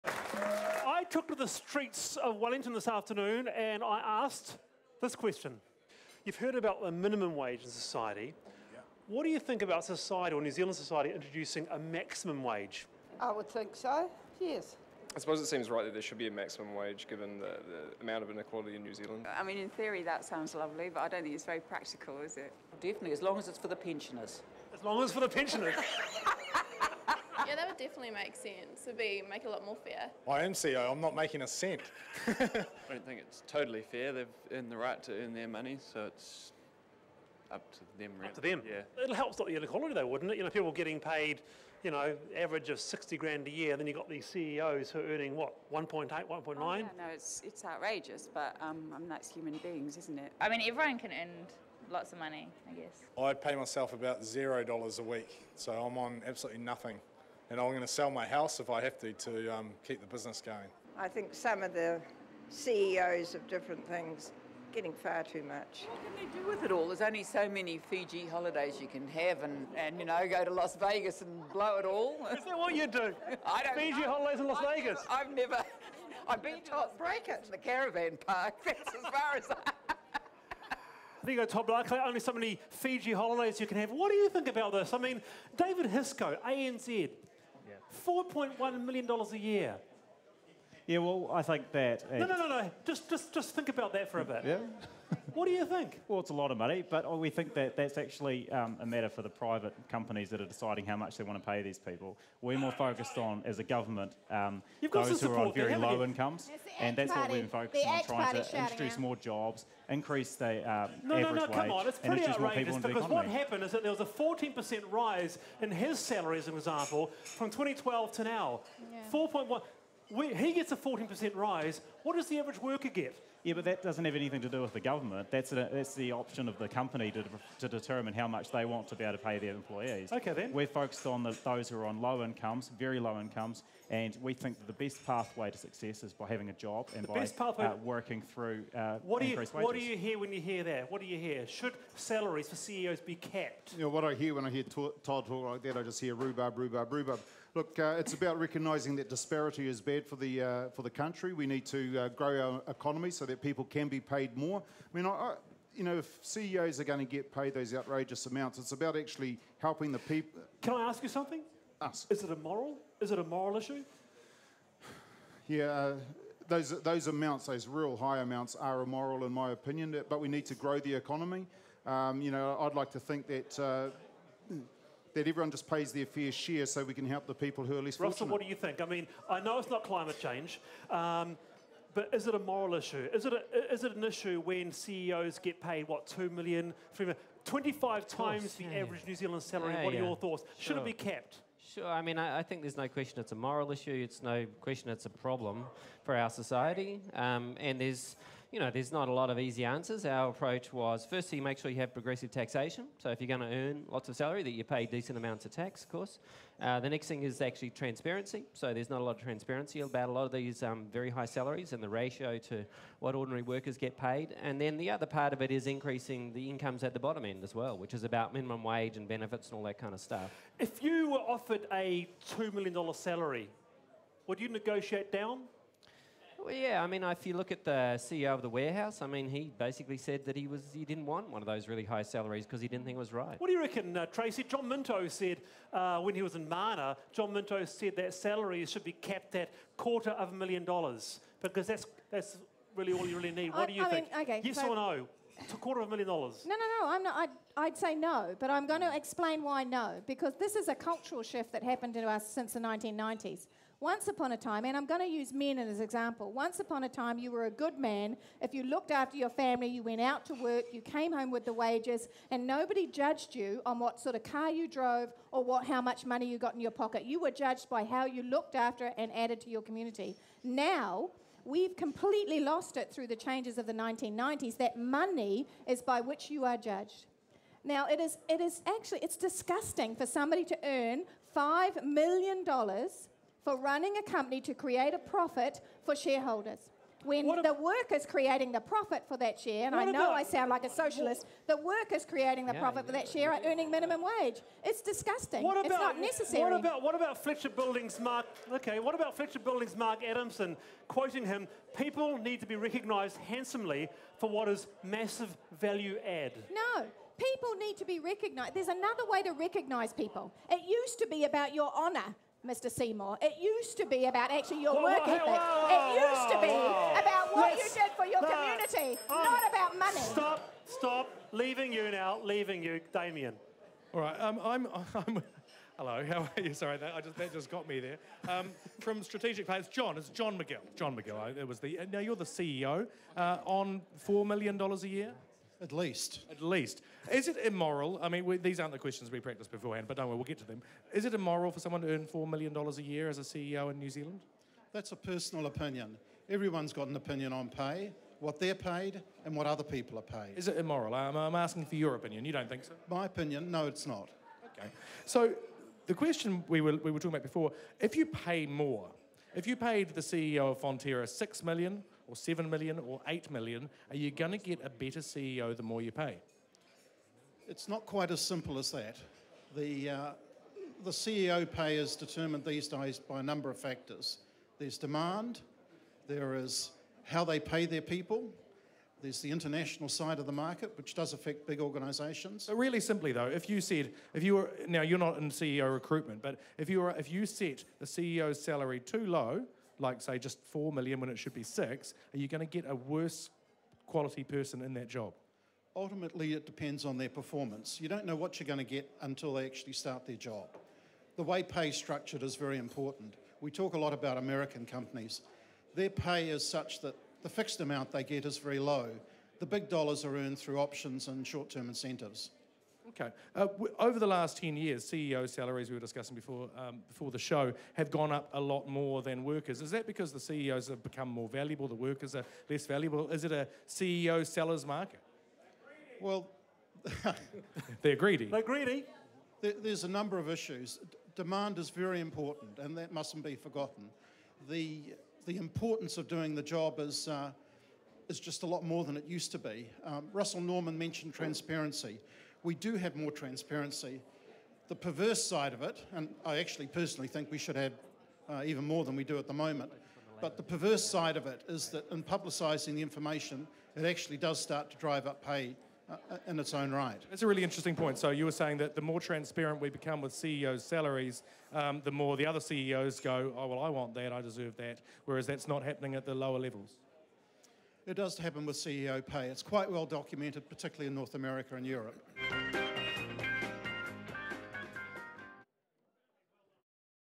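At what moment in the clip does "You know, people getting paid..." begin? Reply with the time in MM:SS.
00:40.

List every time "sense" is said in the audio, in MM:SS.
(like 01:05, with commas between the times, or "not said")
00:28.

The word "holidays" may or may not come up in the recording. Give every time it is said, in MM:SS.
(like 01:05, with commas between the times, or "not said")
01:08, 01:14, 01:23.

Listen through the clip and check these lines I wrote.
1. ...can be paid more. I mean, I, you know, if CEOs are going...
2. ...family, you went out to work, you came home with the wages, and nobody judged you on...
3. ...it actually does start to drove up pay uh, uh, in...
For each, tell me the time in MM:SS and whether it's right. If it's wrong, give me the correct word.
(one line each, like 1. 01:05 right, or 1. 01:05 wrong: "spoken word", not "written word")
1. 02:33 right
2. 04:19 right
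3. 07:33 wrong: "drive", not "drove".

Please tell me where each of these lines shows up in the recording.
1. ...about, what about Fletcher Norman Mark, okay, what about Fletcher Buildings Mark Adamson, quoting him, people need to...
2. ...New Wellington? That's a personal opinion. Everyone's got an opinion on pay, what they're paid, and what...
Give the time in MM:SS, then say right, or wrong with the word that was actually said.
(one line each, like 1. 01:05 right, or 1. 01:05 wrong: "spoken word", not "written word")
1. 04:56 wrong: "Buildings", not "Norman"
2. 05:43 wrong: "Zealand", not "Wellington".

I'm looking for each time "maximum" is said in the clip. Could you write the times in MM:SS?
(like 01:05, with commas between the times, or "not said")
00:11, 00:16.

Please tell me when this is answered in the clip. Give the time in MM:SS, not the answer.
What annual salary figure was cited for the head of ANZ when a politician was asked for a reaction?
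01:28.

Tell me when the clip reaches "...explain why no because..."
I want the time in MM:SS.
04:08.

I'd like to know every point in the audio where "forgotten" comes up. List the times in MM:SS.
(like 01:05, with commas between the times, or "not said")
07:13.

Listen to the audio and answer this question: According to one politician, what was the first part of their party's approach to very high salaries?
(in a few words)
progressive taxation.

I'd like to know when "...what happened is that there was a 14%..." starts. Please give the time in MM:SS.
01:53.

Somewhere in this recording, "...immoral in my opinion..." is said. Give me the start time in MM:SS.
02:48.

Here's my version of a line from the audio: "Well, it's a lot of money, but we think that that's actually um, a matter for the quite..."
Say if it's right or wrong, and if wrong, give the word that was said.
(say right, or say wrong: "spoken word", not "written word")
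wrong: "private", not "quite".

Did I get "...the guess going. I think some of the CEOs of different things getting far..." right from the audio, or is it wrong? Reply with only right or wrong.
wrong.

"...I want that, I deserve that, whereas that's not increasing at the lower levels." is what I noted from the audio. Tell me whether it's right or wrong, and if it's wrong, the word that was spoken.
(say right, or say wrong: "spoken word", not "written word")
wrong: "happening", not "increasing".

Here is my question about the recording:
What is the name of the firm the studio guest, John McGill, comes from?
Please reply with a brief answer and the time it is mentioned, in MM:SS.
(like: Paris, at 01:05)
Strategic Plans, at 05:29.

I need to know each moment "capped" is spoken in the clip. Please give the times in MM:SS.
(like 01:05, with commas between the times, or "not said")
02:23, 03:10, 03:58.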